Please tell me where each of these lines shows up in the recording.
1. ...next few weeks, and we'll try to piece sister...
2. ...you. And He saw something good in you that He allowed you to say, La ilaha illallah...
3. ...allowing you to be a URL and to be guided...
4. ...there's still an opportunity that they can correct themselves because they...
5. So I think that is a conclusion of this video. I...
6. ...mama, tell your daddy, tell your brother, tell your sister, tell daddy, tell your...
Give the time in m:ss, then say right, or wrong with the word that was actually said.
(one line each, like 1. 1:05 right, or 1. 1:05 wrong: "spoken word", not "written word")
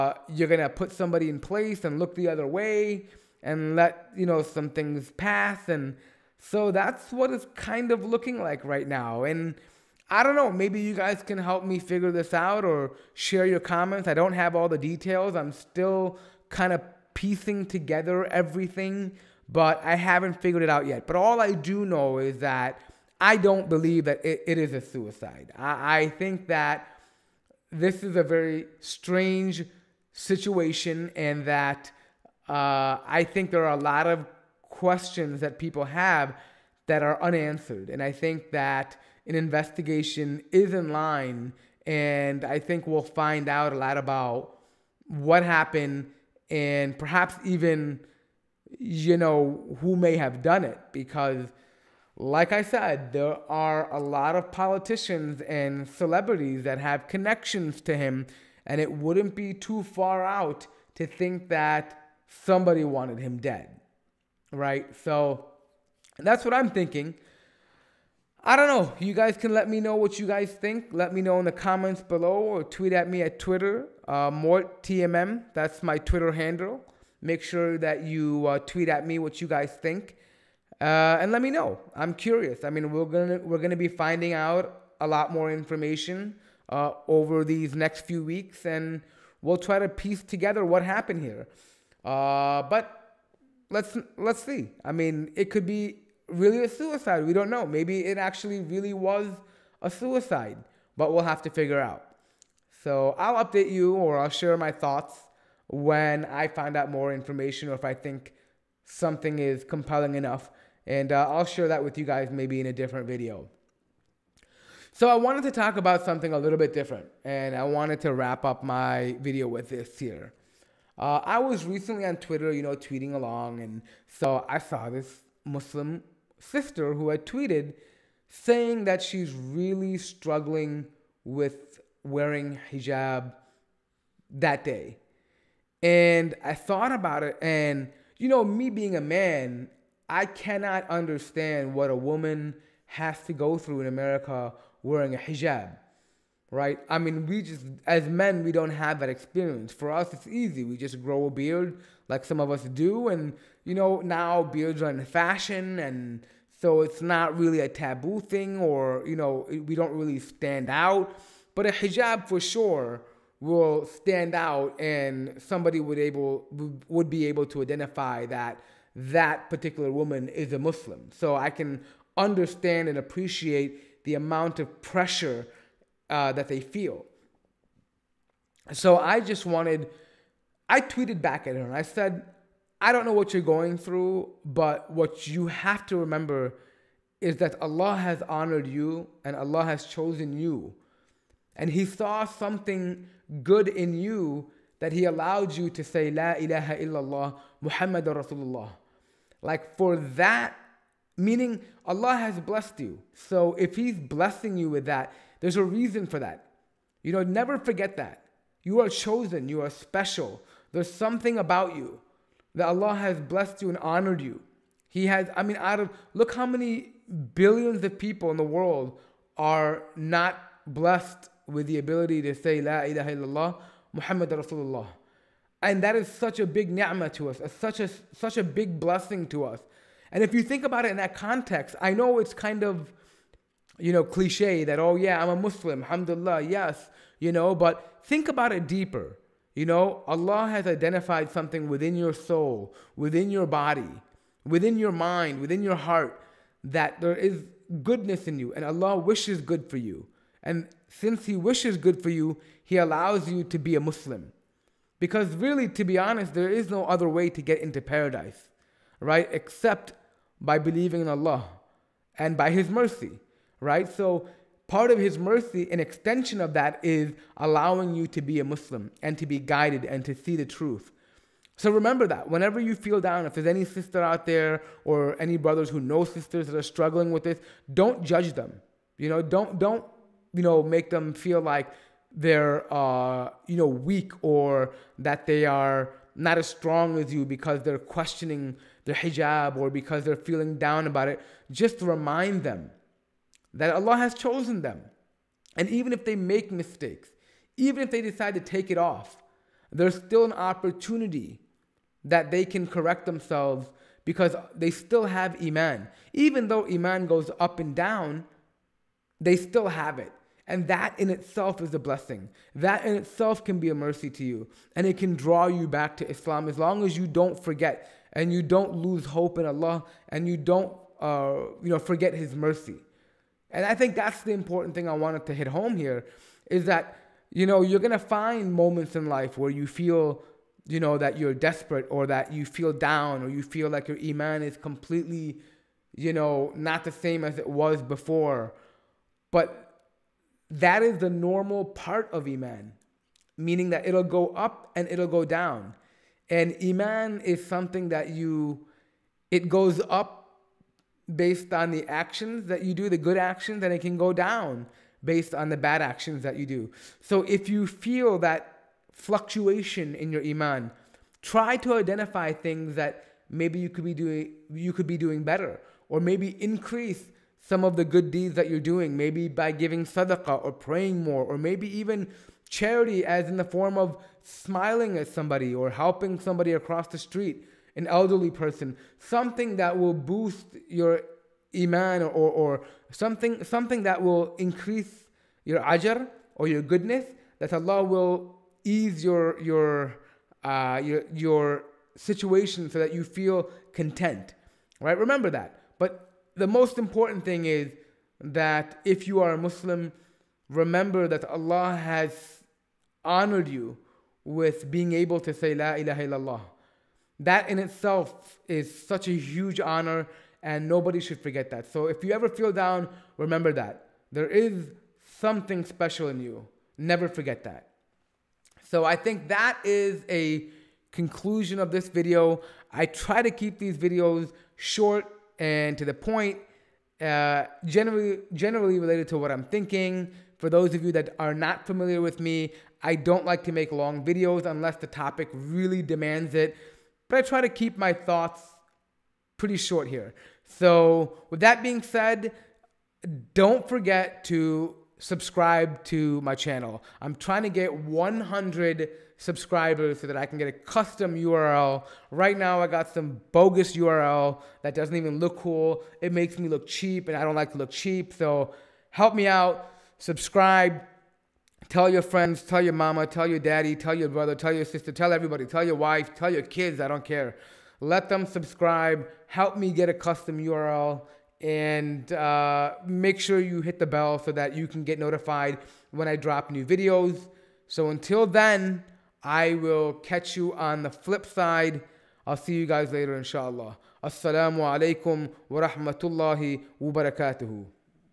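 1. 1:27 wrong: "together", not "sister"
2. 3:10 right
3. 4:27 wrong: "Muslim", not "URL"
4. 4:59 right
5. 6:58 right
6. 7:42 wrong: "everybody", not "daddy".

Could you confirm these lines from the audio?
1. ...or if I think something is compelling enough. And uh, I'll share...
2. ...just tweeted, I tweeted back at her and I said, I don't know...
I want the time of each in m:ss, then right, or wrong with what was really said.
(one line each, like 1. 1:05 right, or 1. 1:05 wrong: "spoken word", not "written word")
1. 1:47 right
2. 2:59 wrong: "wanted", not "tweeted".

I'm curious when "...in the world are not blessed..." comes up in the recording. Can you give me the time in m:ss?
3:38.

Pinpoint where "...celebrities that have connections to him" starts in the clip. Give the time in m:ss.
0:55.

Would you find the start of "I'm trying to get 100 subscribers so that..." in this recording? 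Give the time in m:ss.
7:27.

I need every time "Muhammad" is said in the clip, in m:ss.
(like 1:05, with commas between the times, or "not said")
3:17, 3:43.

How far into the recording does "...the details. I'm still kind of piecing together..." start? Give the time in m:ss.
0:14.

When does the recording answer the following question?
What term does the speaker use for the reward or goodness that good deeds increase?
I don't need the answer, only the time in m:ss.
6:25.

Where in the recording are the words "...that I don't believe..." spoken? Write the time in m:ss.
0:22.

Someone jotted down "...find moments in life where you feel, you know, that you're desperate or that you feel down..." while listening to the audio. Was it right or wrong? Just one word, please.
right.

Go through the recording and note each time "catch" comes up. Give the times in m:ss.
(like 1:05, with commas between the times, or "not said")
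7:59.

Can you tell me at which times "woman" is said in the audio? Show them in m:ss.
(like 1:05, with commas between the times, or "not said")
2:21, 2:49.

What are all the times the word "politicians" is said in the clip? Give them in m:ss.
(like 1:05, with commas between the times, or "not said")
0:54.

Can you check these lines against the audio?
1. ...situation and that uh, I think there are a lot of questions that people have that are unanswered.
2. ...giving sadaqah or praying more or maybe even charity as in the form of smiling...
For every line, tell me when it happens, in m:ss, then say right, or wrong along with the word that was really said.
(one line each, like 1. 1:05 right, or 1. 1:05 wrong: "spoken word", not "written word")
1. 0:30 right
2. 6:09 right.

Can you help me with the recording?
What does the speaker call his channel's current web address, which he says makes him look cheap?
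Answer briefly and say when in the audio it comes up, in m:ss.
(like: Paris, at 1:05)
Bogus URL, at 7:33.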